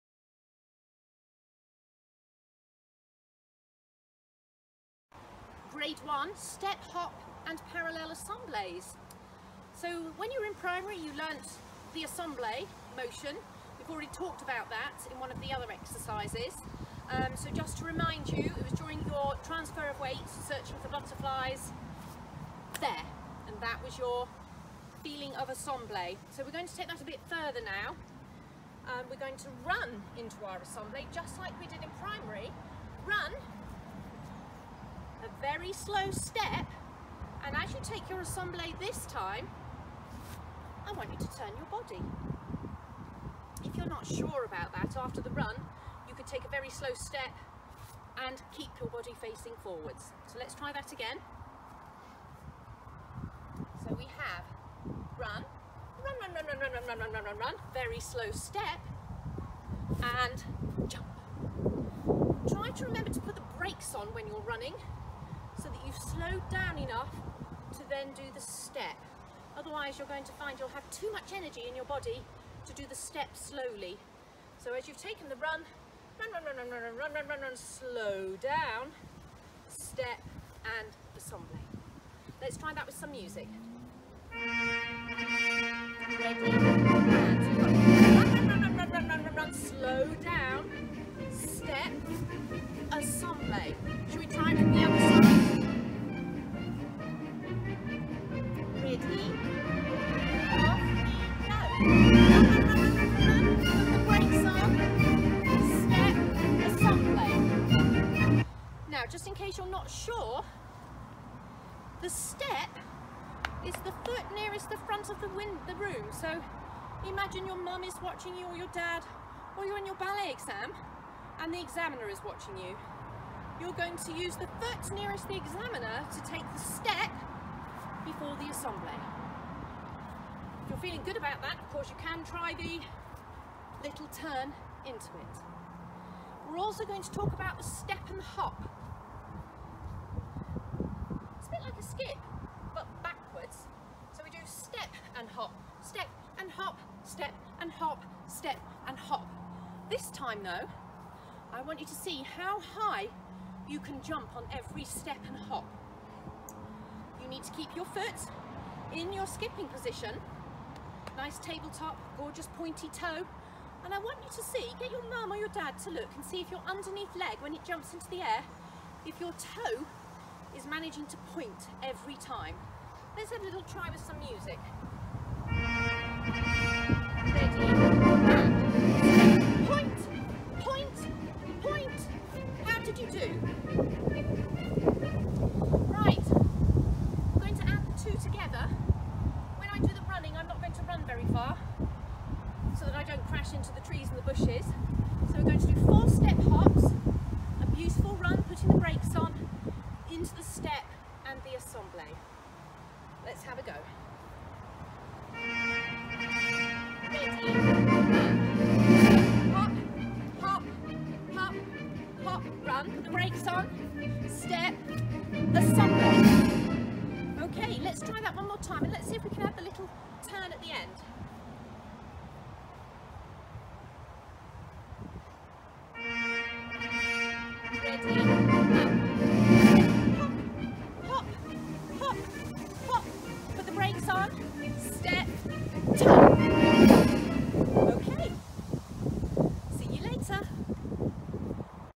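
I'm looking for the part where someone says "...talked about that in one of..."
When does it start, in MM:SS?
00:14.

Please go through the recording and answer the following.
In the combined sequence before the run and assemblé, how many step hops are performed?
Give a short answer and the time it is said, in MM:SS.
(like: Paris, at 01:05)
4, at 03:15.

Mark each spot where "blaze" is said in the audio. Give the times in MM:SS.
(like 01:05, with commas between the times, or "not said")
not said.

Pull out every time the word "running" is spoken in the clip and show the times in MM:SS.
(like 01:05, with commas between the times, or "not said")
01:04.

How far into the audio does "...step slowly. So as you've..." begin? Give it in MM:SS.
01:12.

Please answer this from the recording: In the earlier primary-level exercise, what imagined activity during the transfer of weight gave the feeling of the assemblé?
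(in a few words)
searching for butterflies.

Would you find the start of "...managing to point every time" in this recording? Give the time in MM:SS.
02:50.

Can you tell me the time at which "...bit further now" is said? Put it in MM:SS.
00:27.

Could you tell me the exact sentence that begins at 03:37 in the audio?
Okay, let's try that one more time and let's see if we can have the little turn at the end.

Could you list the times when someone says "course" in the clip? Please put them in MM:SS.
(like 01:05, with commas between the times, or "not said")
02:11.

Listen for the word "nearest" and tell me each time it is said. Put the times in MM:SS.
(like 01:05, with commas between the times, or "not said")
01:54, 02:04.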